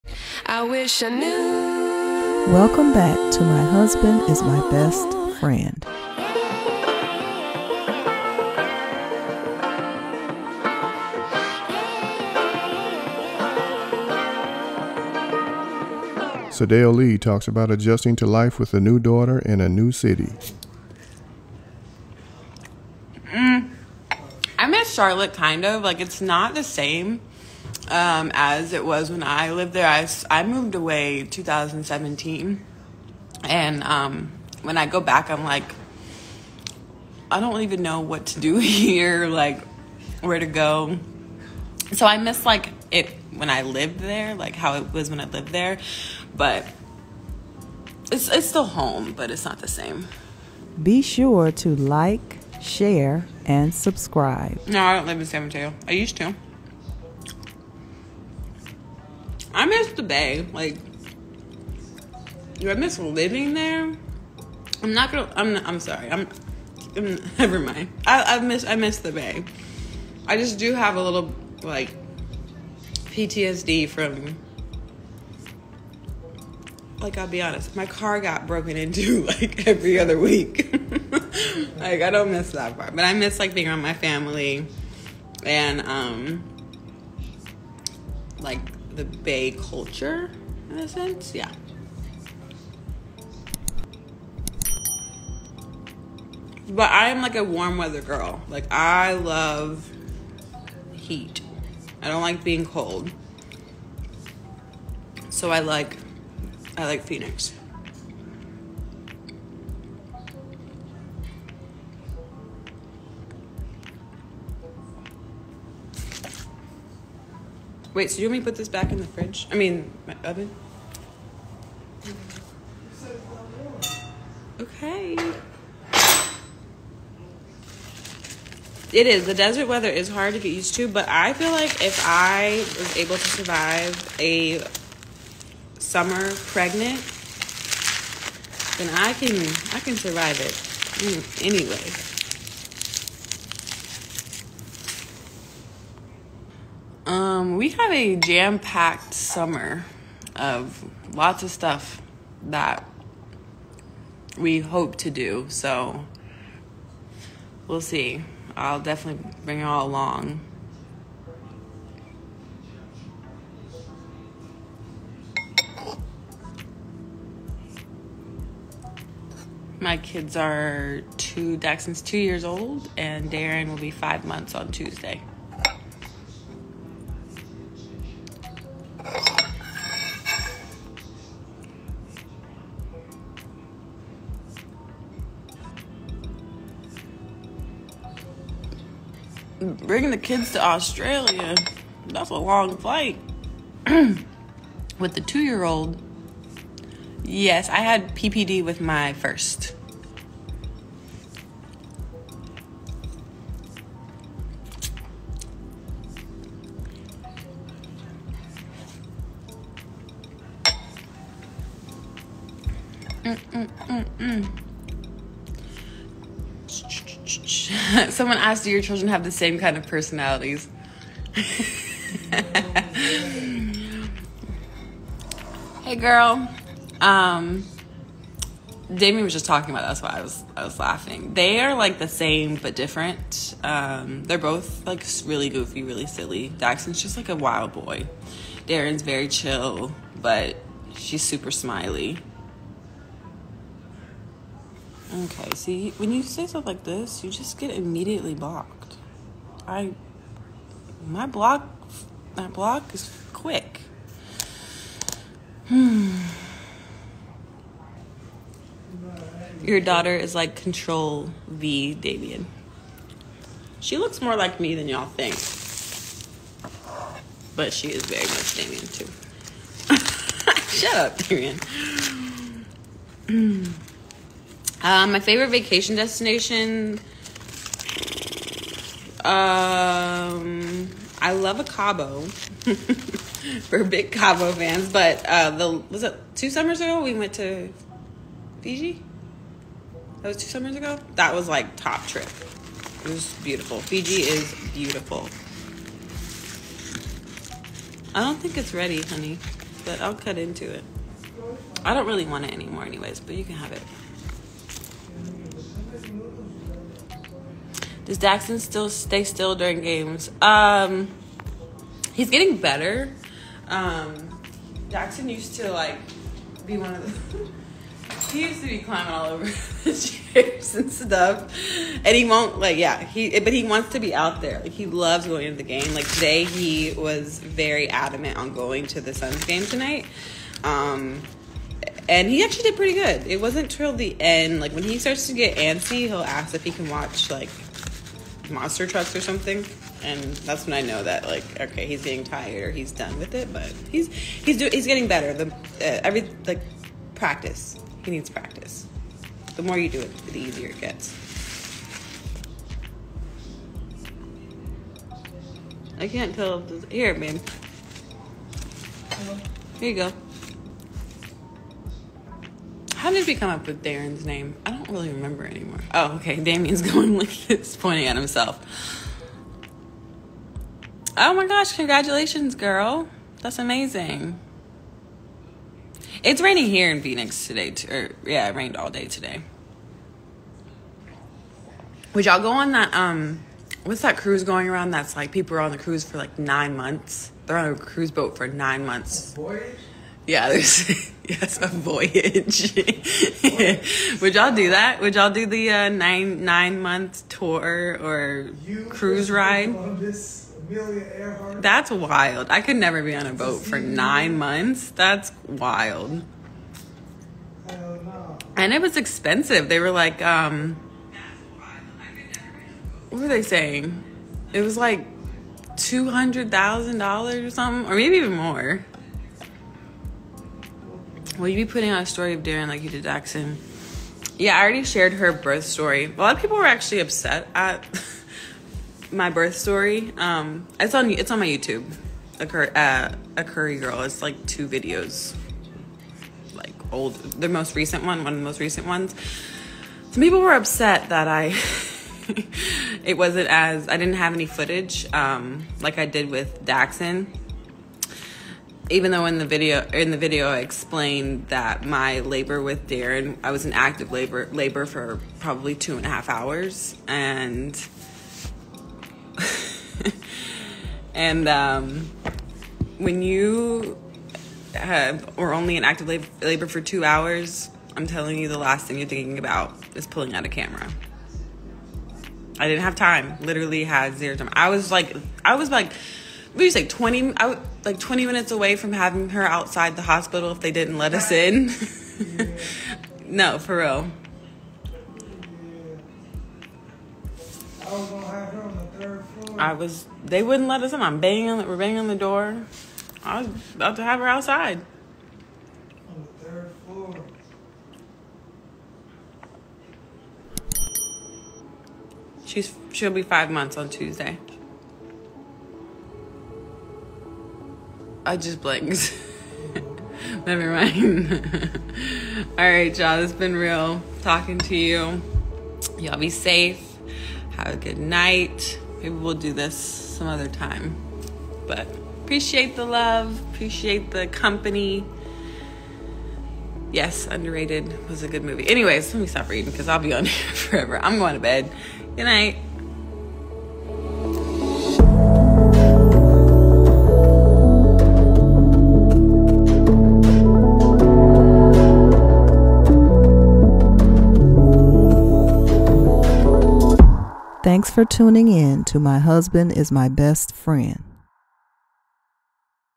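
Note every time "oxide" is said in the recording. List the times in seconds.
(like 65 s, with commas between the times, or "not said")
not said.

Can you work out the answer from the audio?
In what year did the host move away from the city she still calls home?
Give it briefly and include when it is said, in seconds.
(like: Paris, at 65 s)
2017, at 31 s.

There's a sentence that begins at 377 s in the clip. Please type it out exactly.
Or, yeah, it rained all day today.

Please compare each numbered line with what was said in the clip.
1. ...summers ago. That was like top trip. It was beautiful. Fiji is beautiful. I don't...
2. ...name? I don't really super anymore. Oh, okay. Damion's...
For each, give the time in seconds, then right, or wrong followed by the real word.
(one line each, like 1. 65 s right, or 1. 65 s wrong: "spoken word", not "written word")
1. 290 s right
2. 364 s wrong: "remember", not "super".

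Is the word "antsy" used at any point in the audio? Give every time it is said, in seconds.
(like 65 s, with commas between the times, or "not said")
335 s.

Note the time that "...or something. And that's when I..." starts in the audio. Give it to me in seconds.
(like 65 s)
339 s.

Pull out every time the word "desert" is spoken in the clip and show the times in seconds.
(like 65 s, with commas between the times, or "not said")
129 s.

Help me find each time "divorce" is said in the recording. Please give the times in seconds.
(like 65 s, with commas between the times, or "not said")
not said.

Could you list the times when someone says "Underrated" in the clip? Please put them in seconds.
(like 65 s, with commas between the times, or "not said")
527 s.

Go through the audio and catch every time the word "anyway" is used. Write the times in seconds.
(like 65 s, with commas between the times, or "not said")
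141 s, 302 s, 528 s.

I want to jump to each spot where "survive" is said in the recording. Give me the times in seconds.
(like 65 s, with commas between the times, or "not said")
133 s, 139 s.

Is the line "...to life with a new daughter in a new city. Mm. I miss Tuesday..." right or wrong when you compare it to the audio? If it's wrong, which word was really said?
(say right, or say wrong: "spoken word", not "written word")
wrong: "Charlotte", not "Tuesday".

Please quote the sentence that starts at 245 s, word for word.
Okay, see, when you say stuff like this, you just get immediately blocked.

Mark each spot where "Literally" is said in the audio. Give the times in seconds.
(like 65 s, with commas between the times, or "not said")
473 s.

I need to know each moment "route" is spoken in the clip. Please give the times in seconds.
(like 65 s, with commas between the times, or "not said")
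not said.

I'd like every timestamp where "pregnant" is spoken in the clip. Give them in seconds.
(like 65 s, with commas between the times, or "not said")
136 s.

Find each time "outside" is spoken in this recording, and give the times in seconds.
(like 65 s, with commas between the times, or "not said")
479 s, 494 s.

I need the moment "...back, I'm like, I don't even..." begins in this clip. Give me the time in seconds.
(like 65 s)
35 s.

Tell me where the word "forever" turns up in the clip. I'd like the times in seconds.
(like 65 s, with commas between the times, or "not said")
530 s.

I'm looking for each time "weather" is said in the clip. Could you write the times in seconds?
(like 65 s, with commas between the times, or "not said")
97 s, 129 s.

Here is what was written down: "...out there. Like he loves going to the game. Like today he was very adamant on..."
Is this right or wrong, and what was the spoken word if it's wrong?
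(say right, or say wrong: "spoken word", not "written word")
right.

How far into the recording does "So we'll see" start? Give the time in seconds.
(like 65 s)
155 s.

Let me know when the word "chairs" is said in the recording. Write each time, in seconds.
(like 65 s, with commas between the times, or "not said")
319 s.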